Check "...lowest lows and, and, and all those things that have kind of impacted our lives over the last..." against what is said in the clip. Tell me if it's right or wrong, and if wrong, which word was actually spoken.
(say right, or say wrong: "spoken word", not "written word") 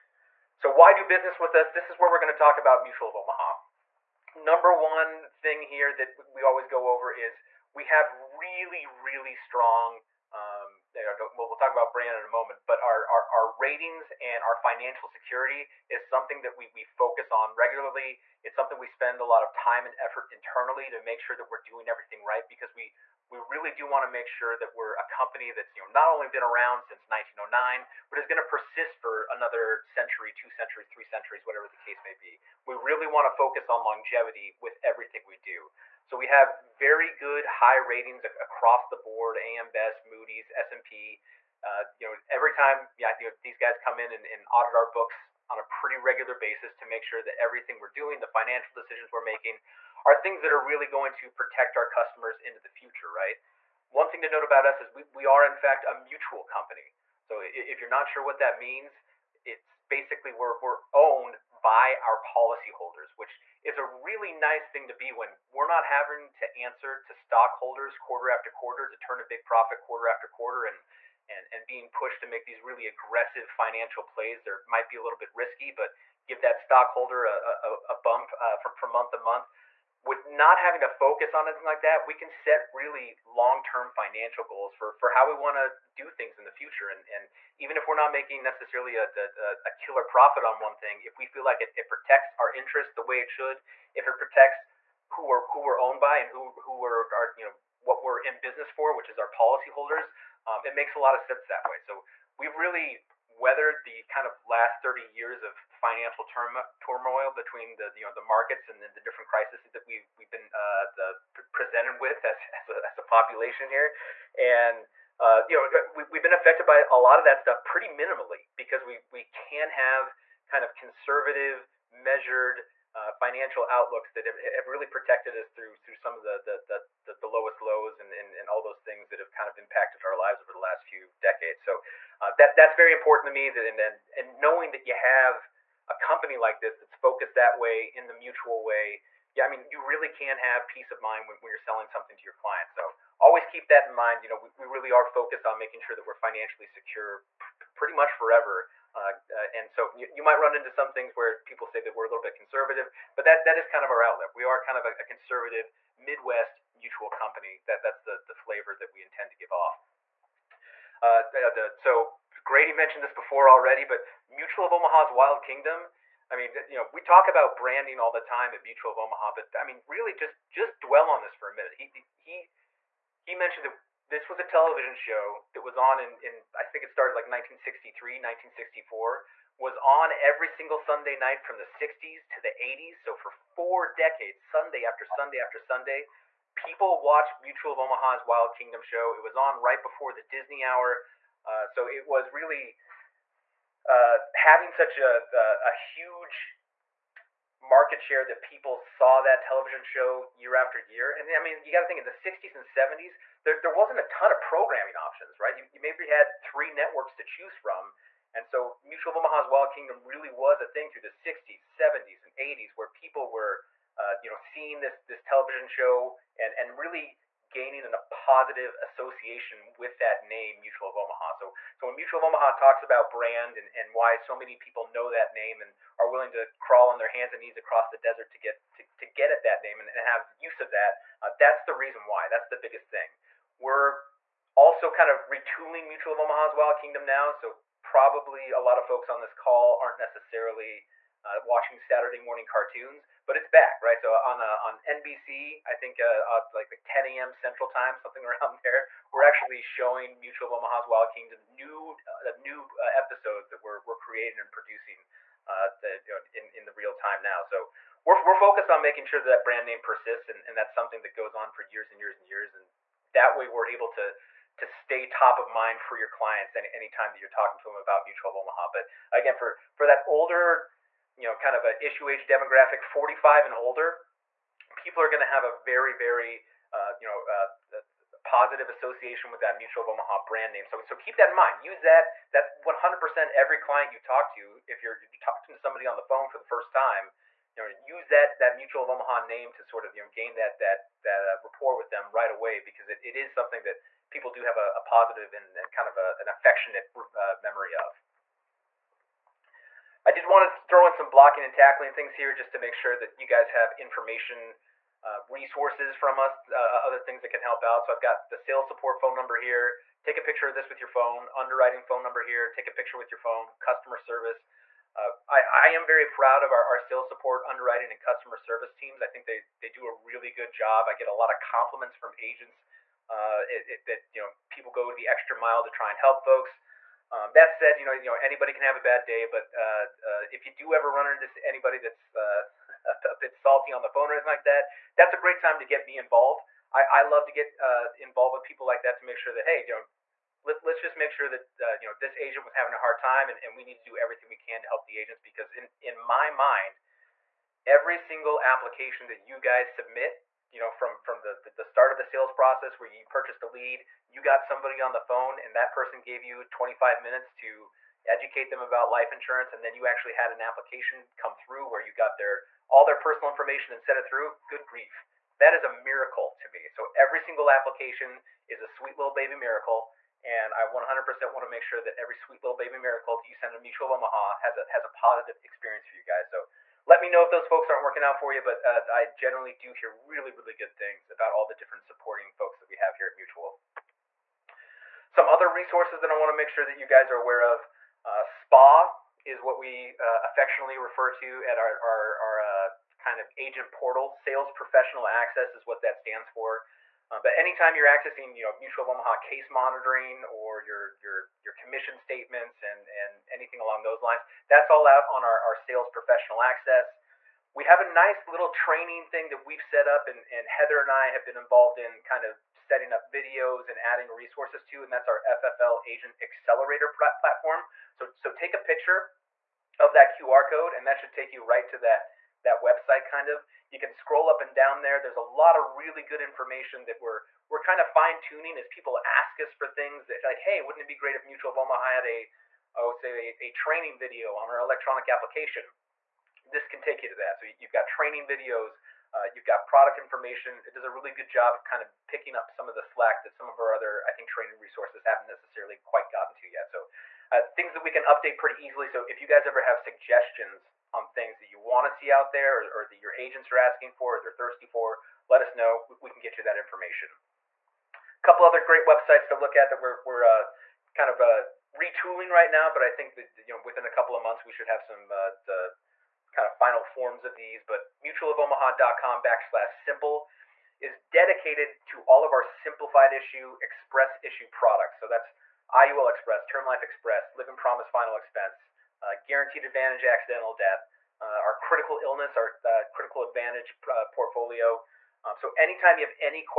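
right.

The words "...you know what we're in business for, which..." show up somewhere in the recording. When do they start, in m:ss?
1:37.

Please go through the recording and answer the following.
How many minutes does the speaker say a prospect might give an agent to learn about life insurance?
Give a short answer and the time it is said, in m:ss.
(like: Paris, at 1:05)
25 minutes, at 5:56.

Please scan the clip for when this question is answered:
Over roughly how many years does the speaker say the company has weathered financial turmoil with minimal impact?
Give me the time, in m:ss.
1:44.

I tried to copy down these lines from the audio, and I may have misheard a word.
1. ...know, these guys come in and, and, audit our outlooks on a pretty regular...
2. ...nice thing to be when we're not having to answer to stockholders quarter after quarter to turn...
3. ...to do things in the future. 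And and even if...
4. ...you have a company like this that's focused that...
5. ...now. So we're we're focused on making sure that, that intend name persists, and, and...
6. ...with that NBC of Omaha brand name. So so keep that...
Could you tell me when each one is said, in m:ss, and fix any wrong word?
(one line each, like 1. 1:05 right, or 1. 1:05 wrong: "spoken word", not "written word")
1. 0:43 wrong: "books", not "outlooks"
2. 1:04 right
3. 1:25 right
4. 2:14 right
5. 4:17 wrong: "brand", not "intend"
6. 4:39 wrong: "Mutual", not "NBC".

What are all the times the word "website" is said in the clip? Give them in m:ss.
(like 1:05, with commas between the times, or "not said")
7:02, 7:38.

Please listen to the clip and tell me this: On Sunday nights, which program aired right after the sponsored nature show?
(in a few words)
the Disney hour.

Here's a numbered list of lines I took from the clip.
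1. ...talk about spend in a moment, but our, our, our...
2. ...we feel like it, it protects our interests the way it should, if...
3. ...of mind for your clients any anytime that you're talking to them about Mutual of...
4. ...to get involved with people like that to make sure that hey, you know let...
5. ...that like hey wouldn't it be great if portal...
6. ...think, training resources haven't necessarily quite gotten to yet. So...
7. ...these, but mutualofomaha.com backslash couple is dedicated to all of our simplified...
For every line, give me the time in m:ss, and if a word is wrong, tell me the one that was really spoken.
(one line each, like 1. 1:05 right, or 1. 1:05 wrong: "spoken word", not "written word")
1. 0:11 wrong: "brand", not "spend"
2. 1:31 right
3. 4:25 right
4. 5:37 right
5. 7:10 wrong: "mutual", not "portal"
6. 7:24 right
7. 7:47 wrong: "simple", not "couple".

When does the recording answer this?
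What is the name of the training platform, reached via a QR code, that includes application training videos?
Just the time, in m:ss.
6:55.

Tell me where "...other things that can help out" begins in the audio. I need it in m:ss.
5:06.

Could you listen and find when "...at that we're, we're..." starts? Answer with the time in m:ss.
7:39.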